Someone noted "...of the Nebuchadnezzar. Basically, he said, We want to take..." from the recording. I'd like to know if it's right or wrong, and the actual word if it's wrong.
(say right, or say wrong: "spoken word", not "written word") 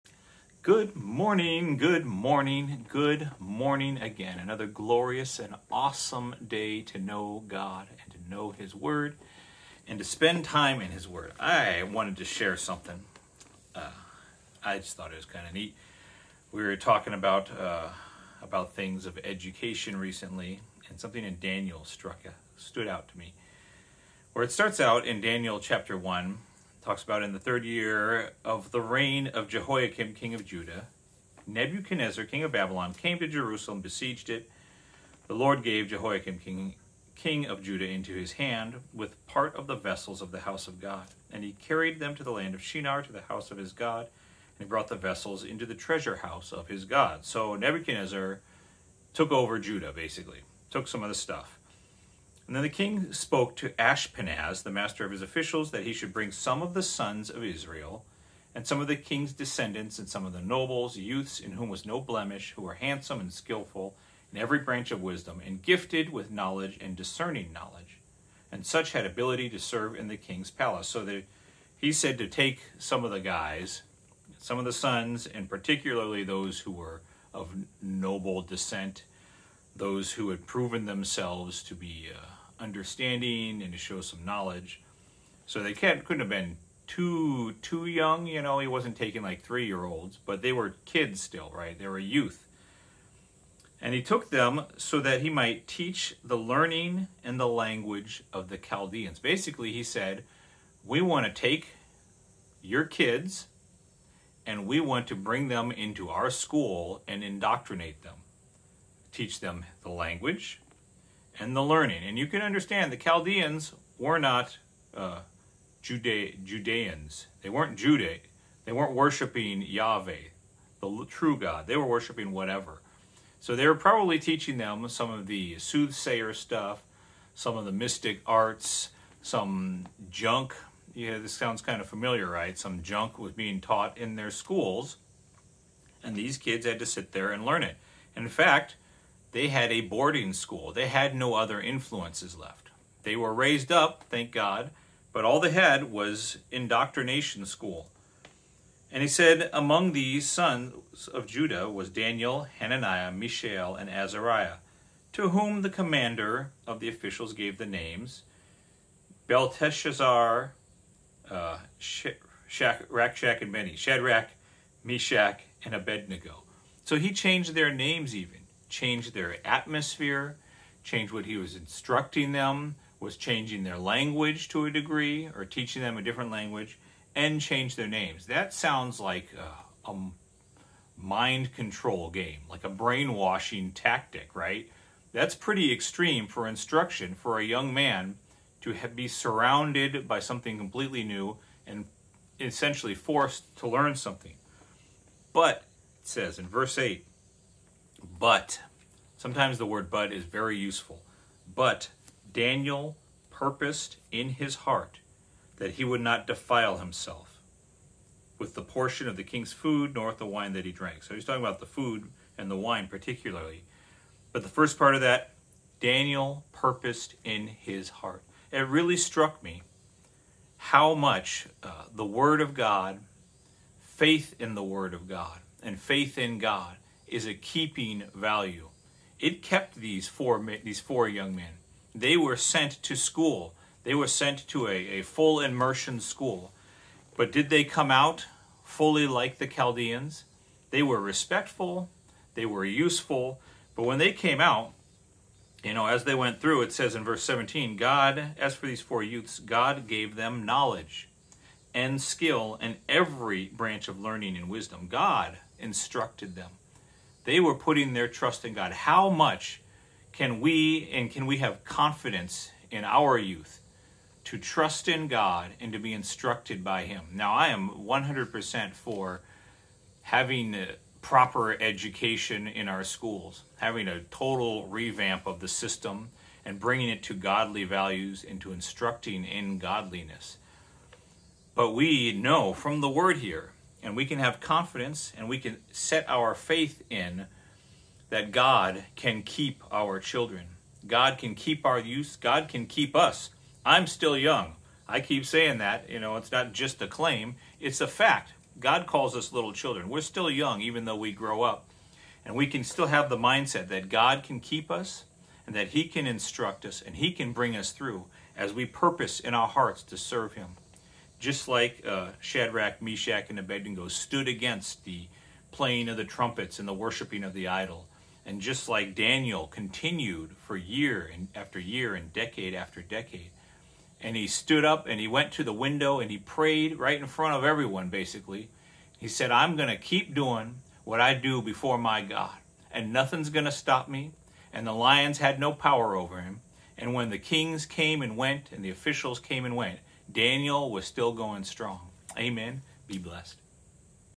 wrong: "Chaldeans", not "Nebuchadnezzar".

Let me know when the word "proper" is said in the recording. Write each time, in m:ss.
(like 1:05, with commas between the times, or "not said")
4:31.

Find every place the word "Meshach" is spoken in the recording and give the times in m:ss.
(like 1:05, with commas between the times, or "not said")
2:44, 5:12.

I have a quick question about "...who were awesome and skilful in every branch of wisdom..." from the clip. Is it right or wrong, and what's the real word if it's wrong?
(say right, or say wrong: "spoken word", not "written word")
wrong: "handsome", not "awesome".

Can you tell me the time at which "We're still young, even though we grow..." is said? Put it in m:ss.
4:59.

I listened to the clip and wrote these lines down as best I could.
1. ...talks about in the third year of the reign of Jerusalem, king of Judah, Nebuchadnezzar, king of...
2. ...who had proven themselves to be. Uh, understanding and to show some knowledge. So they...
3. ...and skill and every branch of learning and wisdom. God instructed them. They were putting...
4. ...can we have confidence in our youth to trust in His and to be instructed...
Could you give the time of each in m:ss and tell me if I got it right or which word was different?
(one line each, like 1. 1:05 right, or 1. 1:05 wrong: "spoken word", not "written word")
1. 0:26 wrong: "Jehoiakim", not "Jerusalem"
2. 1:20 right
3. 4:11 right
4. 4:21 wrong: "God", not "His".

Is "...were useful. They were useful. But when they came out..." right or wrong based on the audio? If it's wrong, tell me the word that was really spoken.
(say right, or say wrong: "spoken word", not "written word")
wrong: "respectful", not "useful".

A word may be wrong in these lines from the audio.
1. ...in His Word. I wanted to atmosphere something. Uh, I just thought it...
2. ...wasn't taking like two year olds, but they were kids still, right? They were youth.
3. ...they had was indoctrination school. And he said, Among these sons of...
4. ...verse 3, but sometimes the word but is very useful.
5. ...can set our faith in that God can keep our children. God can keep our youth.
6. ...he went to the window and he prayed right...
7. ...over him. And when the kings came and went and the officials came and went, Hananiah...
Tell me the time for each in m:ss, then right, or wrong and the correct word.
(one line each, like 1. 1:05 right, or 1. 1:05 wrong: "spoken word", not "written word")
1. 0:10 wrong: "share", not "atmosphere"
2. 1:28 wrong: "three", not "two"
3. 2:25 right
4. 3:16 wrong: "8", not "3"
5. 4:45 right
6. 5:24 right
7. 5:35 wrong: "Daniel", not "Hananiah".